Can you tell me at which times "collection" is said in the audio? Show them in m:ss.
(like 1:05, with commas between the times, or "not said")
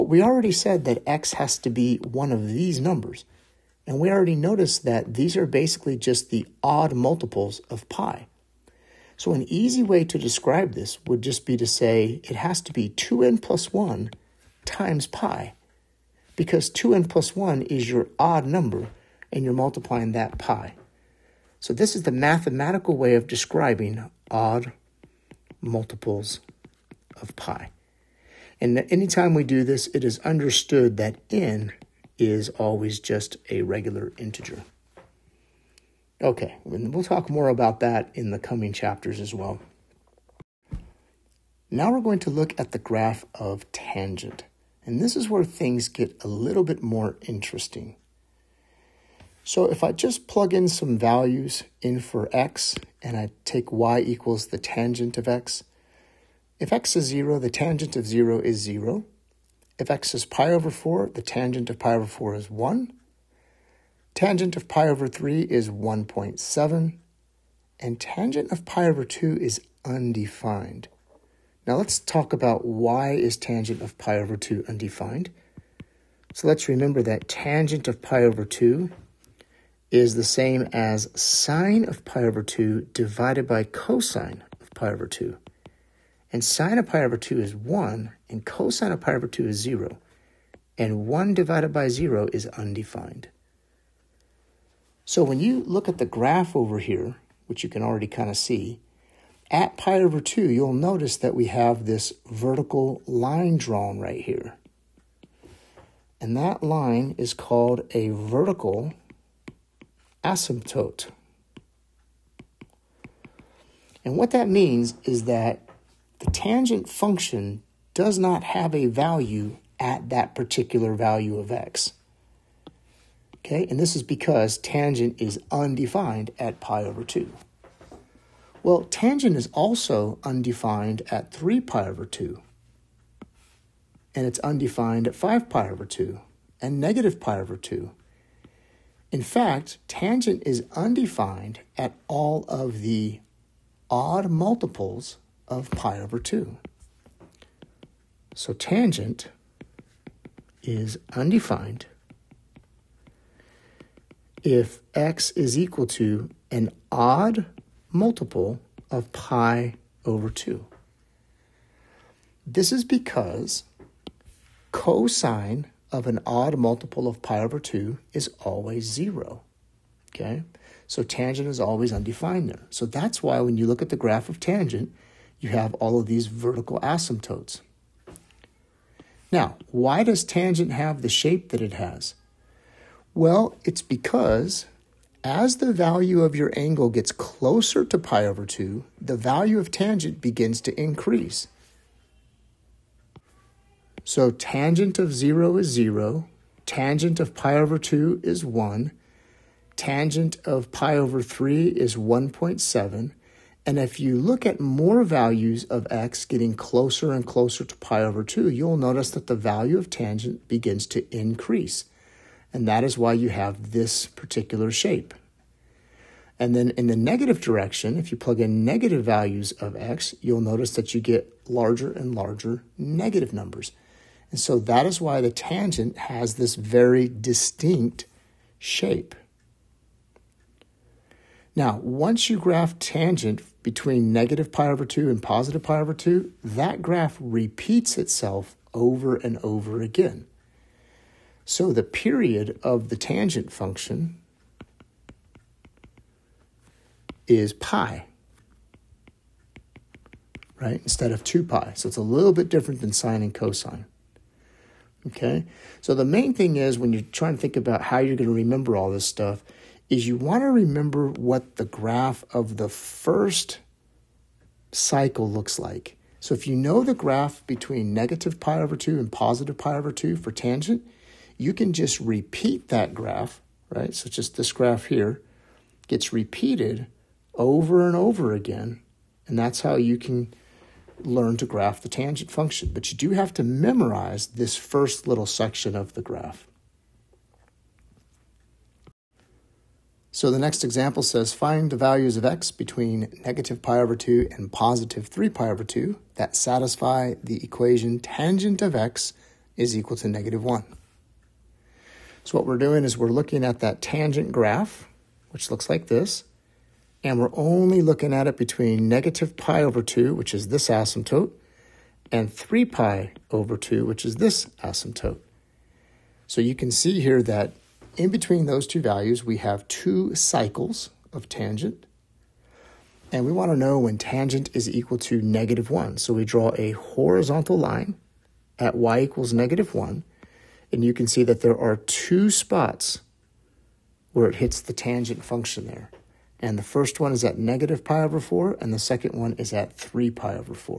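not said.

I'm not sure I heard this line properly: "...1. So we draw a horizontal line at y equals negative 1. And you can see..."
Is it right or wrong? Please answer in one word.
right.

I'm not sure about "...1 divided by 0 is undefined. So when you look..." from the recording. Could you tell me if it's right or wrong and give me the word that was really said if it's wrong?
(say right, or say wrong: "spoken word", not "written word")
right.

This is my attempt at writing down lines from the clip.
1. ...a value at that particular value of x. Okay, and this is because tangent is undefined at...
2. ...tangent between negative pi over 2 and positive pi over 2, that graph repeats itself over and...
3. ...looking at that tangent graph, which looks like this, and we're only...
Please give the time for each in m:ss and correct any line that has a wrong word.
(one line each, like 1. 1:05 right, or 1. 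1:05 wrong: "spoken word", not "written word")
1. 1:58 right
2. 3:52 right
3. 5:03 right.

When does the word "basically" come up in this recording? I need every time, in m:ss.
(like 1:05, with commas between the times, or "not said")
0:05.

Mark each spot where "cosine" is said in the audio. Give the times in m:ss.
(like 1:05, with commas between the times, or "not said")
1:23, 1:28, 2:44, 4:13.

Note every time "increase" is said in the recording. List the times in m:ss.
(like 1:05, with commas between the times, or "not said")
3:10, 3:31.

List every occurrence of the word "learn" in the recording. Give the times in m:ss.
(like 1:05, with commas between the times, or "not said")
4:41.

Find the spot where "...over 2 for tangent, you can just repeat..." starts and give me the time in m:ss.
4:29.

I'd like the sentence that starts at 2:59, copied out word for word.
Now, why does tangent have the shape that it has?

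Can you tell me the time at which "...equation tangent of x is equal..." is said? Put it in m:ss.
4:57.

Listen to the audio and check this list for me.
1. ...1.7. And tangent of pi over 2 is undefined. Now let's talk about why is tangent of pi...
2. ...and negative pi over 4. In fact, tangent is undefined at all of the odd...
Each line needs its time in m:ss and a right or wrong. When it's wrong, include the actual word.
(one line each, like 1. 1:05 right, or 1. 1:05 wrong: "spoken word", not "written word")
1. 1:05 right
2. 2:16 wrong: "2", not "4".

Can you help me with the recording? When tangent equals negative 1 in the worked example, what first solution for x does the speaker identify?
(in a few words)
negative pi over 4.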